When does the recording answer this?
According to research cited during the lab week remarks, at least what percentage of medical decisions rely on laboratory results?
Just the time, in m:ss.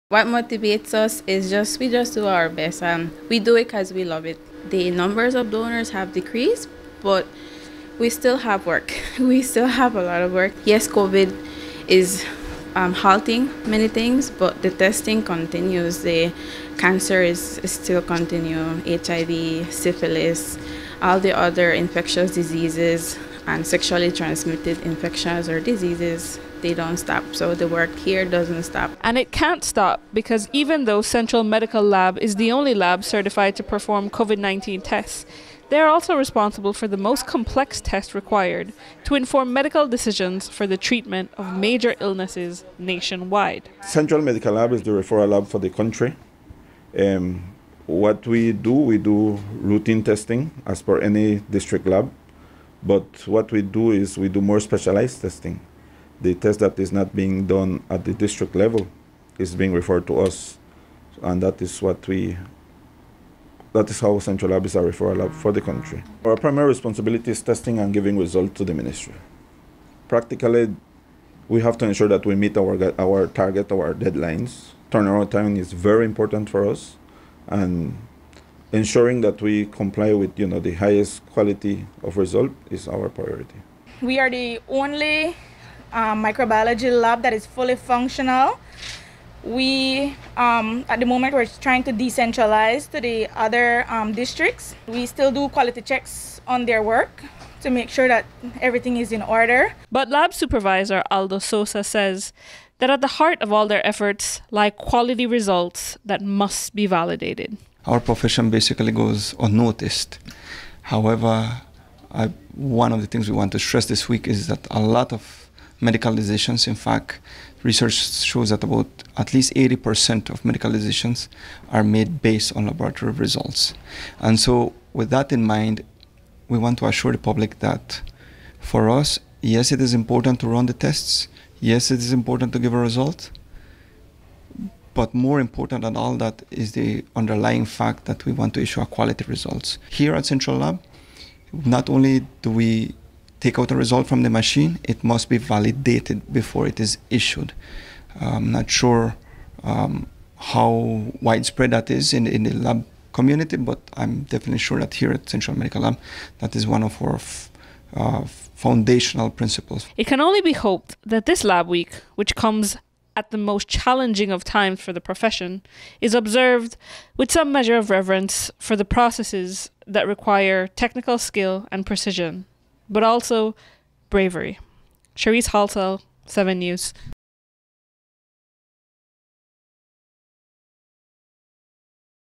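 1:59.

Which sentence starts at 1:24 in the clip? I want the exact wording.
We are the only um, microbiology lab that is fully functional.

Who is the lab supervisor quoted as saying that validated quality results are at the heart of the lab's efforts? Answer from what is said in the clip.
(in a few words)
Aldo Sosa.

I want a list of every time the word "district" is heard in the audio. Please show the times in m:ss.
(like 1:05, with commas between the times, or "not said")
0:51, 0:58, 1:34.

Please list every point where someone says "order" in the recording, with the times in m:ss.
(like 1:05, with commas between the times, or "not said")
1:39.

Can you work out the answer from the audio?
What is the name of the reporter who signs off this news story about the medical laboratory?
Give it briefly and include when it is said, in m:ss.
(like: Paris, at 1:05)
Cherise Halsall, at 2:55.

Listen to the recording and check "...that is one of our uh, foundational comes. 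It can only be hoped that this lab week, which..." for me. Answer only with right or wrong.
wrong.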